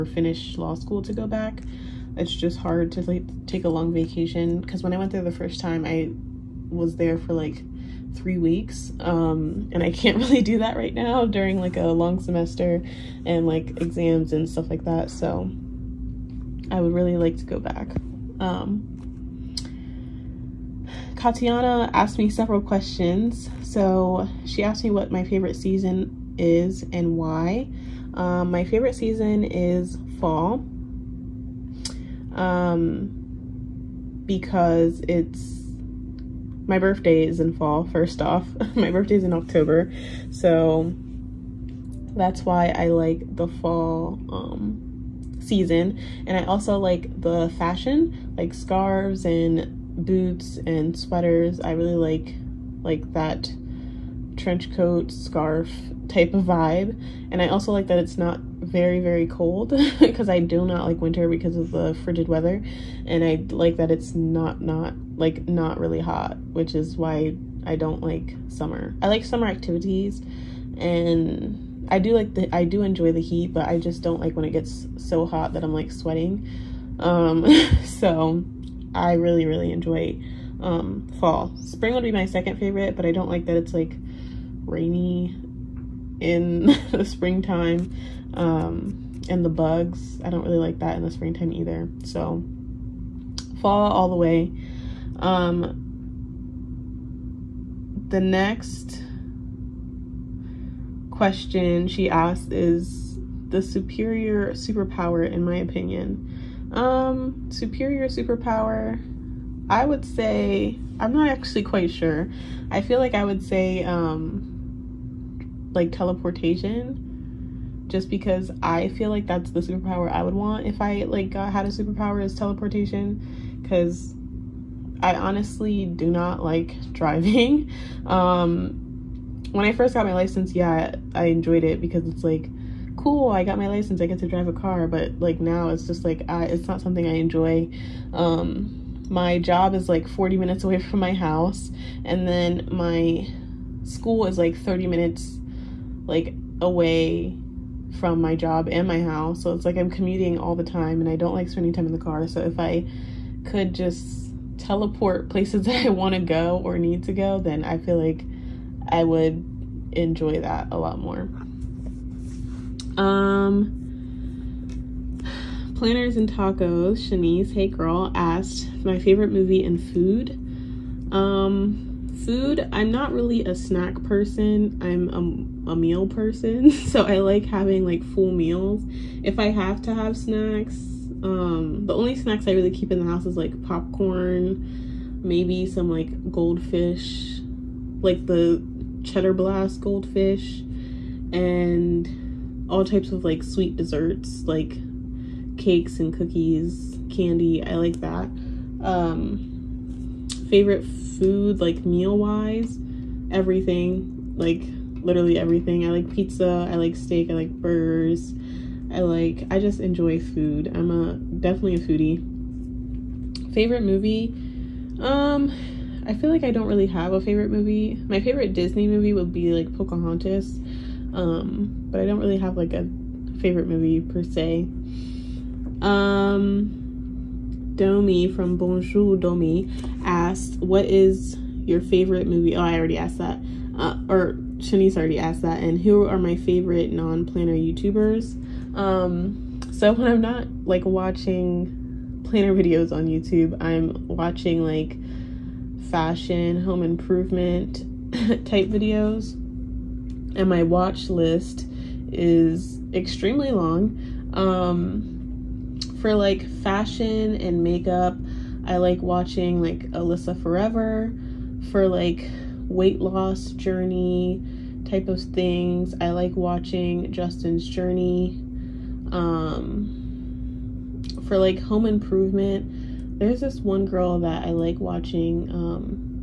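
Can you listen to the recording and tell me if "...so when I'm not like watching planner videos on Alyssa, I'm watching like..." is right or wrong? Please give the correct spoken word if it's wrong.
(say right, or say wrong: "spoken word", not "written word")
wrong: "YouTube", not "Alyssa".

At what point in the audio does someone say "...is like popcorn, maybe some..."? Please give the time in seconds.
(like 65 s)
183 s.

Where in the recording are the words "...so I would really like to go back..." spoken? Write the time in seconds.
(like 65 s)
15 s.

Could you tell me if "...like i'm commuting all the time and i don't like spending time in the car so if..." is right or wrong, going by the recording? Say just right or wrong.
right.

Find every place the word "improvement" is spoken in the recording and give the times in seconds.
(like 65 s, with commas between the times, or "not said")
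246 s, 271 s.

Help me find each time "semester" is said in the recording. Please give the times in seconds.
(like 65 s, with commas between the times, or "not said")
12 s.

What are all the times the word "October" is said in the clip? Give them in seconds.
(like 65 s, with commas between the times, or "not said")
39 s.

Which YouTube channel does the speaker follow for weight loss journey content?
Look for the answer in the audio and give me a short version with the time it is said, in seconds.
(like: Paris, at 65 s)
Justin's Journey, at 267 s.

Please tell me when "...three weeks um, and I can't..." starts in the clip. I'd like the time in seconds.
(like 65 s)
8 s.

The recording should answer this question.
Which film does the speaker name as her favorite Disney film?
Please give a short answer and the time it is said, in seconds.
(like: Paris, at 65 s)
Pocahontas, at 219 s.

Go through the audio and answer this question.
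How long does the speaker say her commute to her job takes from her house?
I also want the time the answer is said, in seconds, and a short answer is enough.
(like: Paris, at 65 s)
40 minutes, at 140 s.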